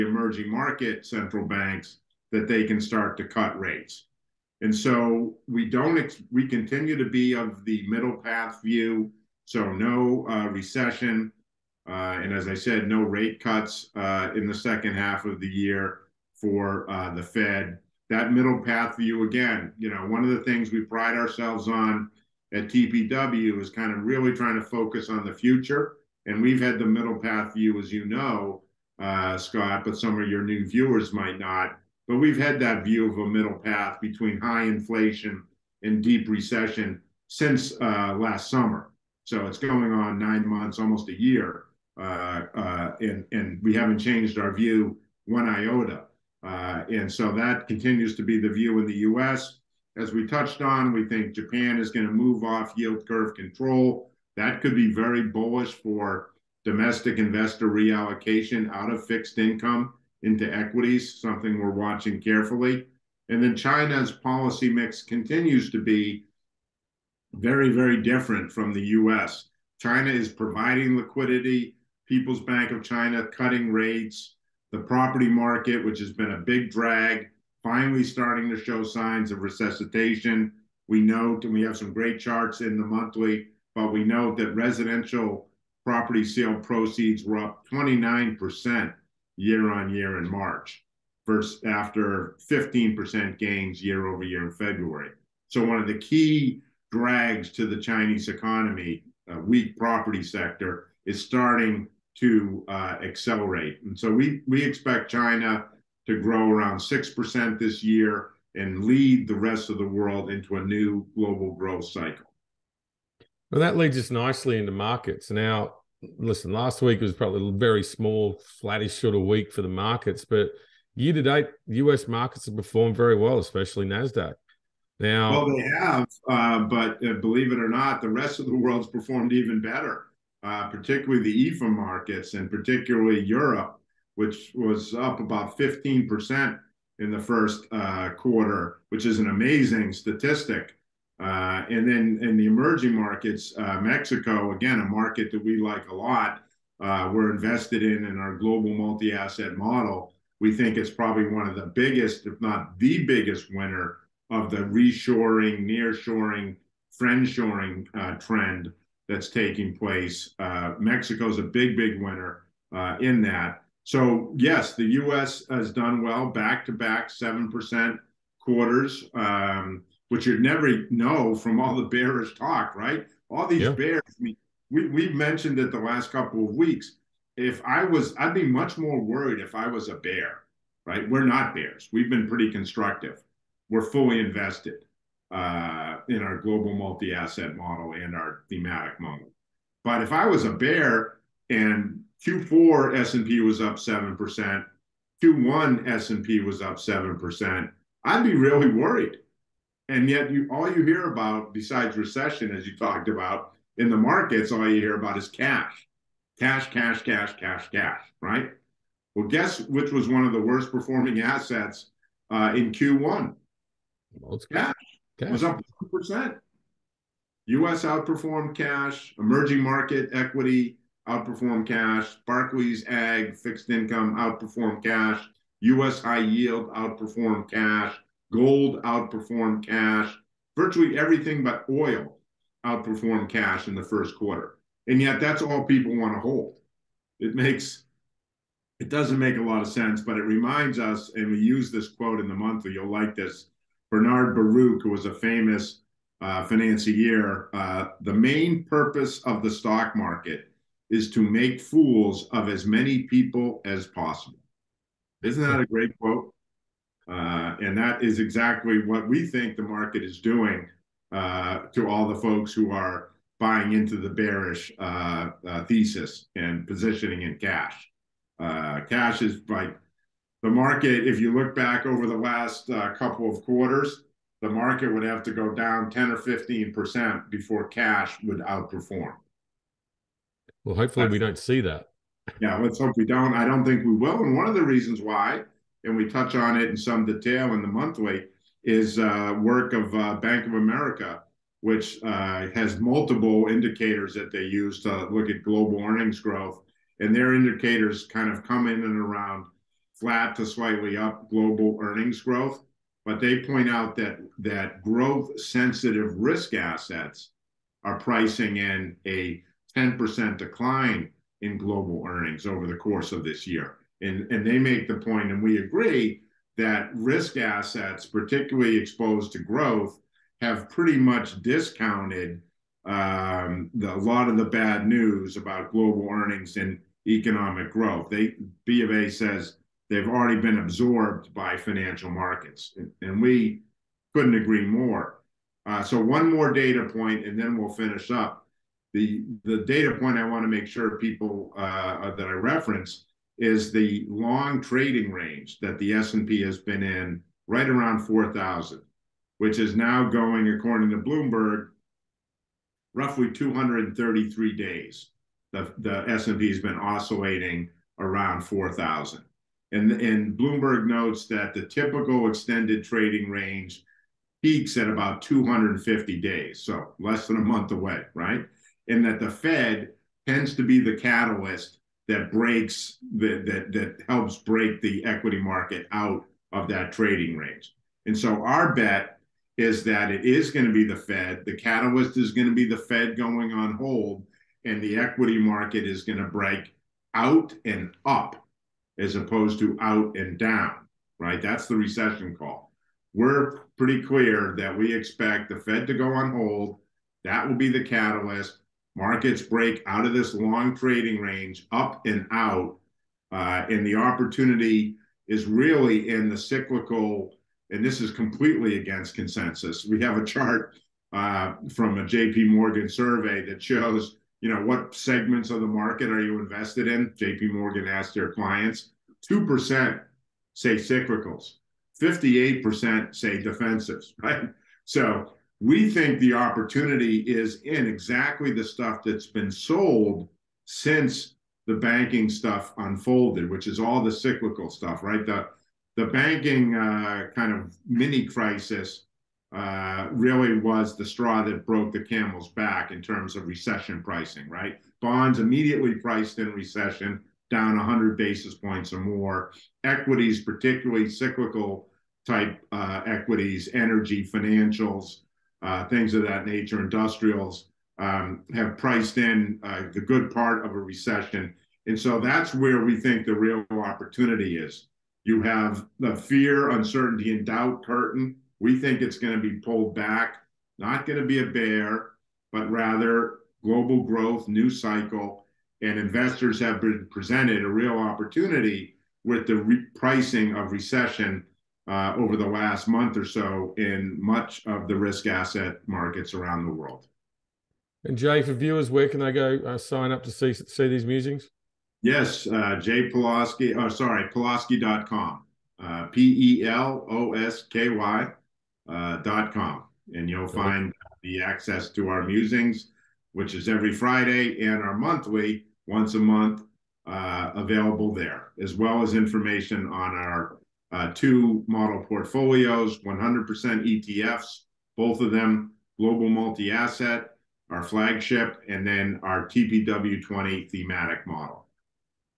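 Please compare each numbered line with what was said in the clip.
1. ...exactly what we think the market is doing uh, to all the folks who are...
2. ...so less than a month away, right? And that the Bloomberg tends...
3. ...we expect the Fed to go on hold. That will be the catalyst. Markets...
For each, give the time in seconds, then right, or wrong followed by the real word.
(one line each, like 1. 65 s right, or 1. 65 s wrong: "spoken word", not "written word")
1. 258 s right
2. 366 s wrong: "Fed", not "Bloomberg"
3. 394 s right.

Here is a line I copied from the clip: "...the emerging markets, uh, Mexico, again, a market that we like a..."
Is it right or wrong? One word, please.
right.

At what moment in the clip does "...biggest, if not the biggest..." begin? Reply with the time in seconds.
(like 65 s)
151 s.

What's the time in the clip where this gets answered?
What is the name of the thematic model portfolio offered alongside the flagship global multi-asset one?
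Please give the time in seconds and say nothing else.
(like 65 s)
519 s.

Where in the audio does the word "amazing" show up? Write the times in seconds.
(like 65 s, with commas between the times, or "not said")
139 s.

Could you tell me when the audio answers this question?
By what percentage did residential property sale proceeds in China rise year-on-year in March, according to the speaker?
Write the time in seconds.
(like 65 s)
87 s.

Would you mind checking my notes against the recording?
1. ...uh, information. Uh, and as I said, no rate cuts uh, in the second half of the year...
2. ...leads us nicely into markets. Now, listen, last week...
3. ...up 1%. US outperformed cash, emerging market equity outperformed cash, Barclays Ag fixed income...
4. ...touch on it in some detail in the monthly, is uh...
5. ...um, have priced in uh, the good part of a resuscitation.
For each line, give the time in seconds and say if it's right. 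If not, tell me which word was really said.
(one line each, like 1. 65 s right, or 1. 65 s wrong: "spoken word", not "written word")
1. 10 s wrong: "recession", not "information"
2. 113 s right
3. 215 s right
4. 286 s right
5. 457 s wrong: "recession", not "resuscitation".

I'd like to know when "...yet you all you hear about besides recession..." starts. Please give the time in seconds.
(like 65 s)
200 s.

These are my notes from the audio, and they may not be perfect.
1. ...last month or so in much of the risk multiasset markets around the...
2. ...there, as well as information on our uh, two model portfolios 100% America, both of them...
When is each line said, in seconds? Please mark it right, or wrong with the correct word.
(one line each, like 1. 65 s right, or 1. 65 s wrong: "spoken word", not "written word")
1. 482 s wrong: "asset", not "multiasset"
2. 508 s wrong: "ETFs", not "America".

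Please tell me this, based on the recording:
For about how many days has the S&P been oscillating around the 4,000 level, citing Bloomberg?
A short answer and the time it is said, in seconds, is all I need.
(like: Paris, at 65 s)
233, at 353 s.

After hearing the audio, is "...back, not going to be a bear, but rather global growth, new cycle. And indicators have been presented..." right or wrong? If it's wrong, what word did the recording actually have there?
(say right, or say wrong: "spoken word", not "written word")
wrong: "investors", not "indicators".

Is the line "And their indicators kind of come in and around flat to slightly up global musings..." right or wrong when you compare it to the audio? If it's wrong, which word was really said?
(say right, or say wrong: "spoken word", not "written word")
wrong: "earnings", not "musings".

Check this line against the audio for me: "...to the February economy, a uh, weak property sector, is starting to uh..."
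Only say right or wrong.
wrong.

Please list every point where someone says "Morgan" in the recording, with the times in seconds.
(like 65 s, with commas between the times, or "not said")
412 s, 417 s.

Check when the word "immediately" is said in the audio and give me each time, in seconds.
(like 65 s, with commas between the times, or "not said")
445 s.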